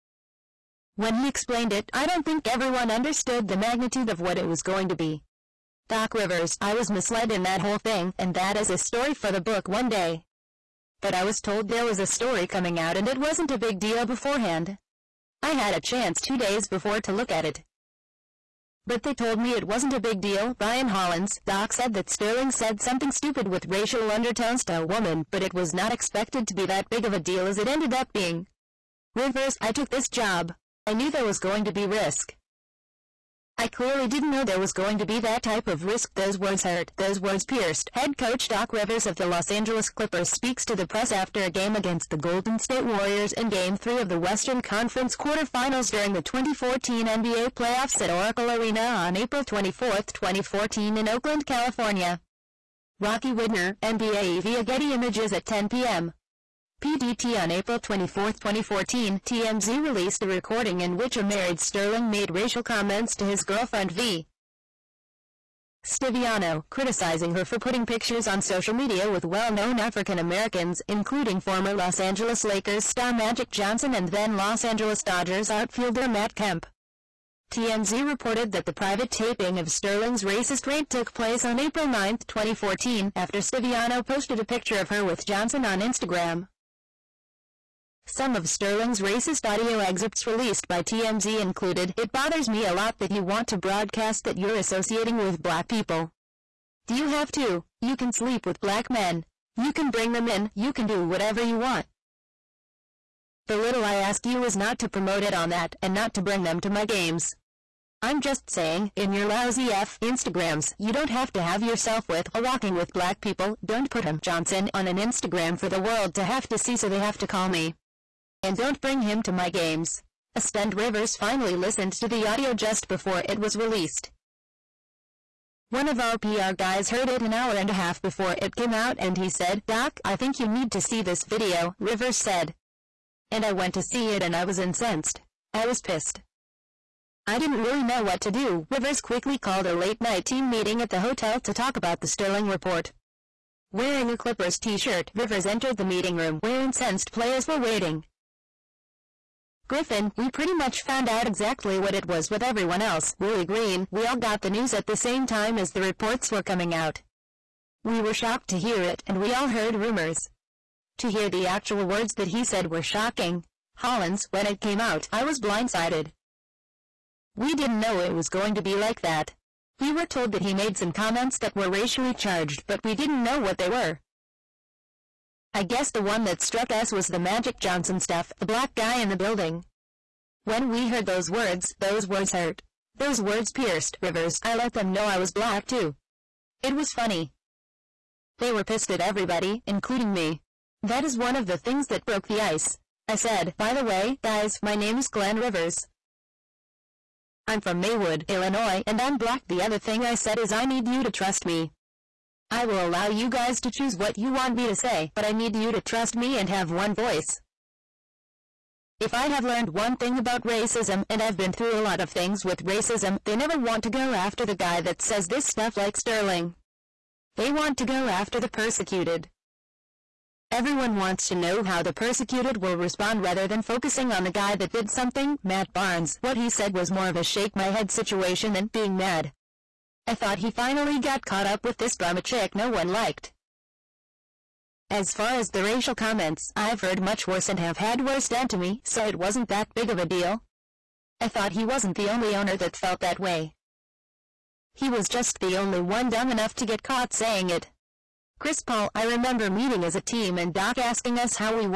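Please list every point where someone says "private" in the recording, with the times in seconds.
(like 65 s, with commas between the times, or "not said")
78 s.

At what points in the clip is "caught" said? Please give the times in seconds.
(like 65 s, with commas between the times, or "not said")
231 s, 246 s.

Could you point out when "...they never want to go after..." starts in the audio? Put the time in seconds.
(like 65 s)
213 s.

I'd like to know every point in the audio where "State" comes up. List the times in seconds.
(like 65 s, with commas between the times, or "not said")
42 s.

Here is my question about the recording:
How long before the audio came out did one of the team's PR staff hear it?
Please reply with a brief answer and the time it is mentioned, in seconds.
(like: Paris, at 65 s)
an hour and a half, at 127 s.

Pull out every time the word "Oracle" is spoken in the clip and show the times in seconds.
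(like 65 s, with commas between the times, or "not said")
48 s.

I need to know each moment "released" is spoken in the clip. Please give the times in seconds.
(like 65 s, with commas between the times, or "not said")
59 s, 90 s, 123 s.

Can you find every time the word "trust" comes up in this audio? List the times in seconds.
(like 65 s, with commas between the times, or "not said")
201 s, 205 s.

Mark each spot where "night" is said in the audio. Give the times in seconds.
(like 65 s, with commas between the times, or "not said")
139 s.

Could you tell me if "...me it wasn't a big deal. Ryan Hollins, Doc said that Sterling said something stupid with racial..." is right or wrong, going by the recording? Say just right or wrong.
right.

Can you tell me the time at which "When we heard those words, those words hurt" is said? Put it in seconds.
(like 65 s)
180 s.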